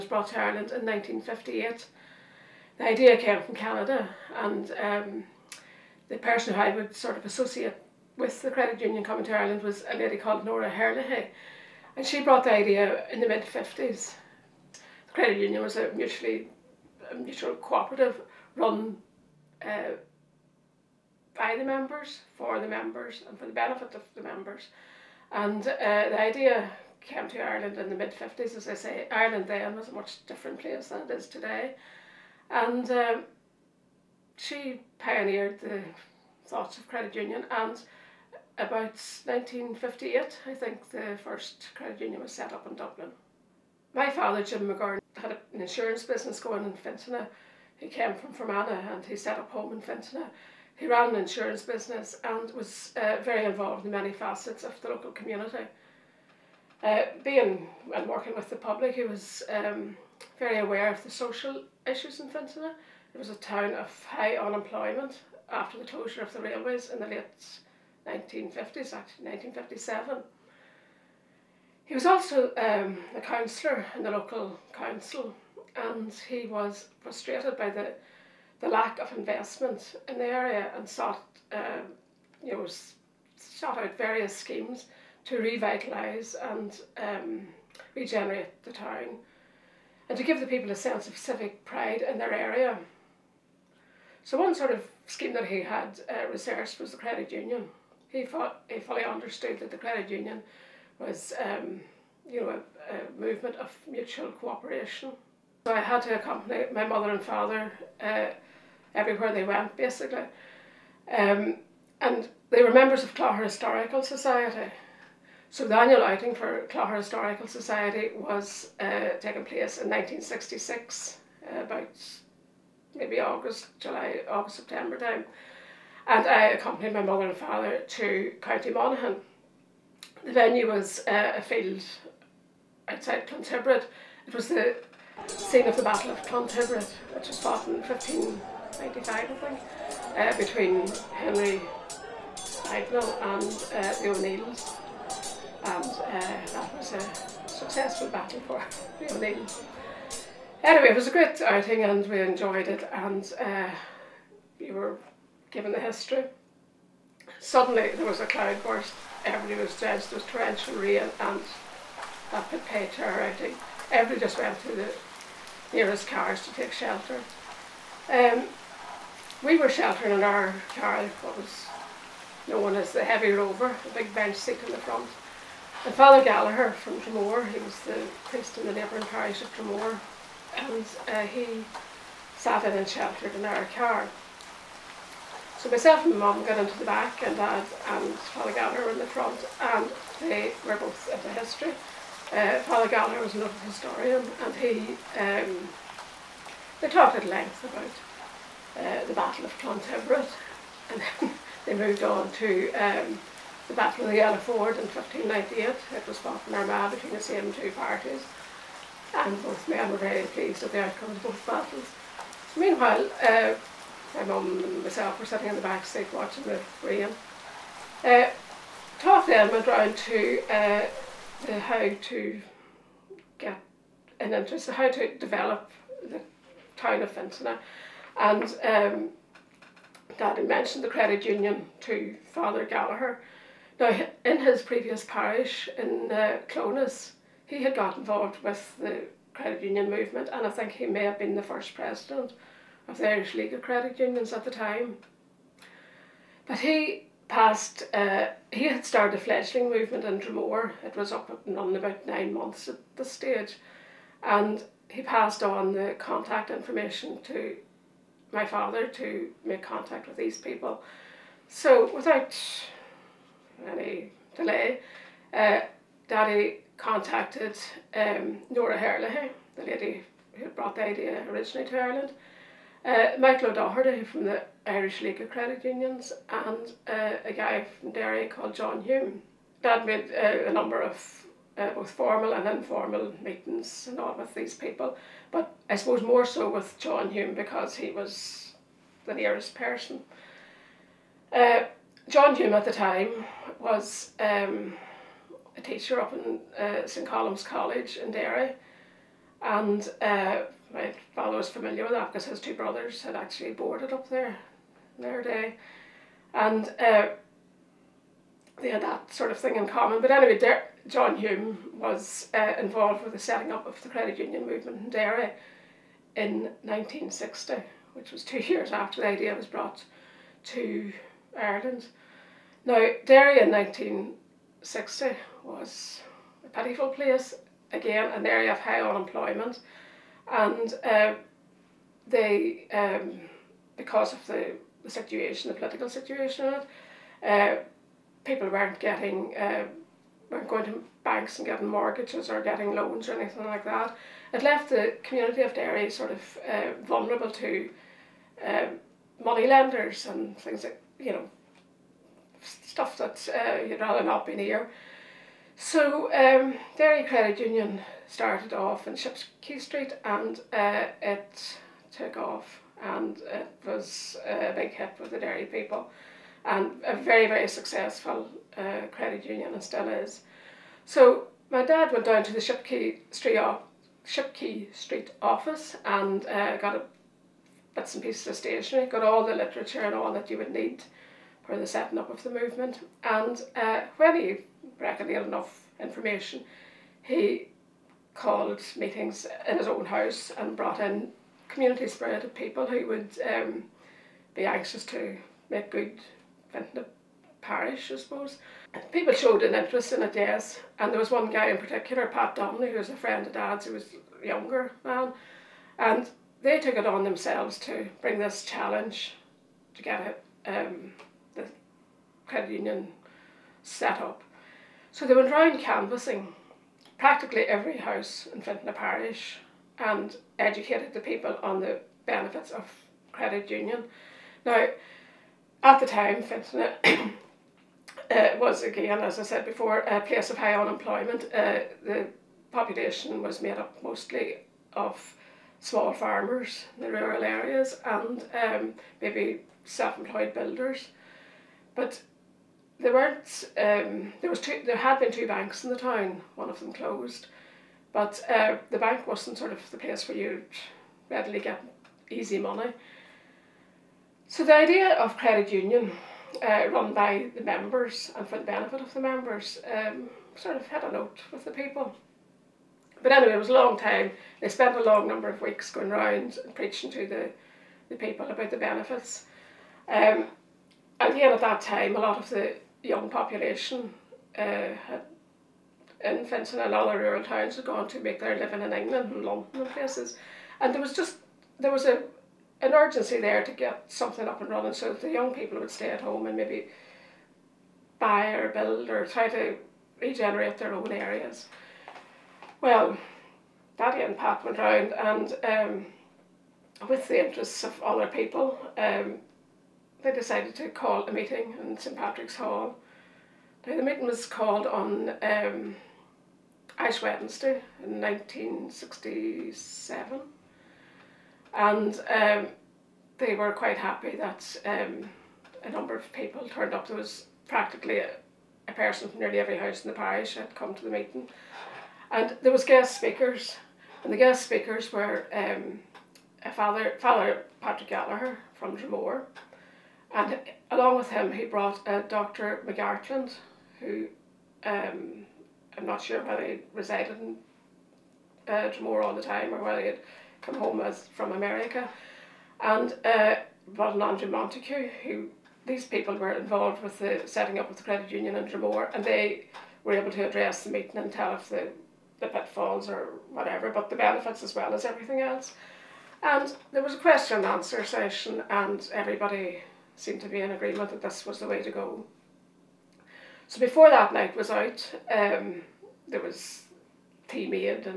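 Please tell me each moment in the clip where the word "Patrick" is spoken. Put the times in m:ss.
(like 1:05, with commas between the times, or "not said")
8:21, 8:47.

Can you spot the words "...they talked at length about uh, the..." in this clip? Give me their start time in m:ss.
3:16.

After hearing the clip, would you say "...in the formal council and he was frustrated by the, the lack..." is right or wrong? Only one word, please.
wrong.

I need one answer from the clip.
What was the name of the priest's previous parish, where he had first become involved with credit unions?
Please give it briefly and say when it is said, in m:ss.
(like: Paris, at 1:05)
Clones, at 3:56.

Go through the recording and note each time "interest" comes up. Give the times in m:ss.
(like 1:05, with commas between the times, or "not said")
3:44, 6:39, 8:17.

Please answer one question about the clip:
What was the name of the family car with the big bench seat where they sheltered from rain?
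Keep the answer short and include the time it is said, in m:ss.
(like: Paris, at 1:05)
Heavy Rover, at 2:53.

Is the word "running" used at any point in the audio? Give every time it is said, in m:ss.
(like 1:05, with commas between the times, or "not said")
4:11, 8:04.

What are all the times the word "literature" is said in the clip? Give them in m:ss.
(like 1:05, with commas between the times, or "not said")
6:19.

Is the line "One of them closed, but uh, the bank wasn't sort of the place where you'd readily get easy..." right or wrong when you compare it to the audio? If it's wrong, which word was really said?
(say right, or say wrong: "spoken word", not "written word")
right.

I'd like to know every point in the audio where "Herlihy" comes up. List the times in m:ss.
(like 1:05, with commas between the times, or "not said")
0:10, 4:28.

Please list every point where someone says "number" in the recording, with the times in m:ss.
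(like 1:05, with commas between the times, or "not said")
4:40, 7:45, 8:35.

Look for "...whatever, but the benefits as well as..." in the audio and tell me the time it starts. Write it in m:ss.
9:13.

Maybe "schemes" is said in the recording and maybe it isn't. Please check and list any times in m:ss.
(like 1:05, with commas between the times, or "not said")
1:24, 1:35.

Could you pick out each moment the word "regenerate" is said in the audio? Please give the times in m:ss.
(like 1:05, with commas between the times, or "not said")
1:27, 8:10.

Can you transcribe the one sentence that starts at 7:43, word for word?
But anyway, it was a long time.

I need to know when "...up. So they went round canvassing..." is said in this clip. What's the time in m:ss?
6:54.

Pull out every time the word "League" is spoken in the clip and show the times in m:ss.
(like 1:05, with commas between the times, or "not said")
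4:03, 4:35.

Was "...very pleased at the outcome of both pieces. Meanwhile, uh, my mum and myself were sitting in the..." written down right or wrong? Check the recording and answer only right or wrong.
wrong.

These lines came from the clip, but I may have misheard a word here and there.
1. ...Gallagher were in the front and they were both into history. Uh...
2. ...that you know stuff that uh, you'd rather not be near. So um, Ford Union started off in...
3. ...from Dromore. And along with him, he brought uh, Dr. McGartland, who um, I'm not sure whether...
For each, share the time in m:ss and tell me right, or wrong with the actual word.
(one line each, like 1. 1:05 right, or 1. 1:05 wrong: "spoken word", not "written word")
1. 3:08 right
2. 5:50 wrong: "Credit", not "Ford"
3. 8:48 right.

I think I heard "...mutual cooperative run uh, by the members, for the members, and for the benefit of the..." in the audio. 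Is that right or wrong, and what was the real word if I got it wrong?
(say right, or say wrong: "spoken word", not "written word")
right.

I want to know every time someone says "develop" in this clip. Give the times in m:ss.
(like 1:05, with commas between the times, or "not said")
3:45.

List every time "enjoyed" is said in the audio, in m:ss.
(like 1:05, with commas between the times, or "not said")
2:32.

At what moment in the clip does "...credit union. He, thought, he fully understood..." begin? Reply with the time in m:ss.
1:36.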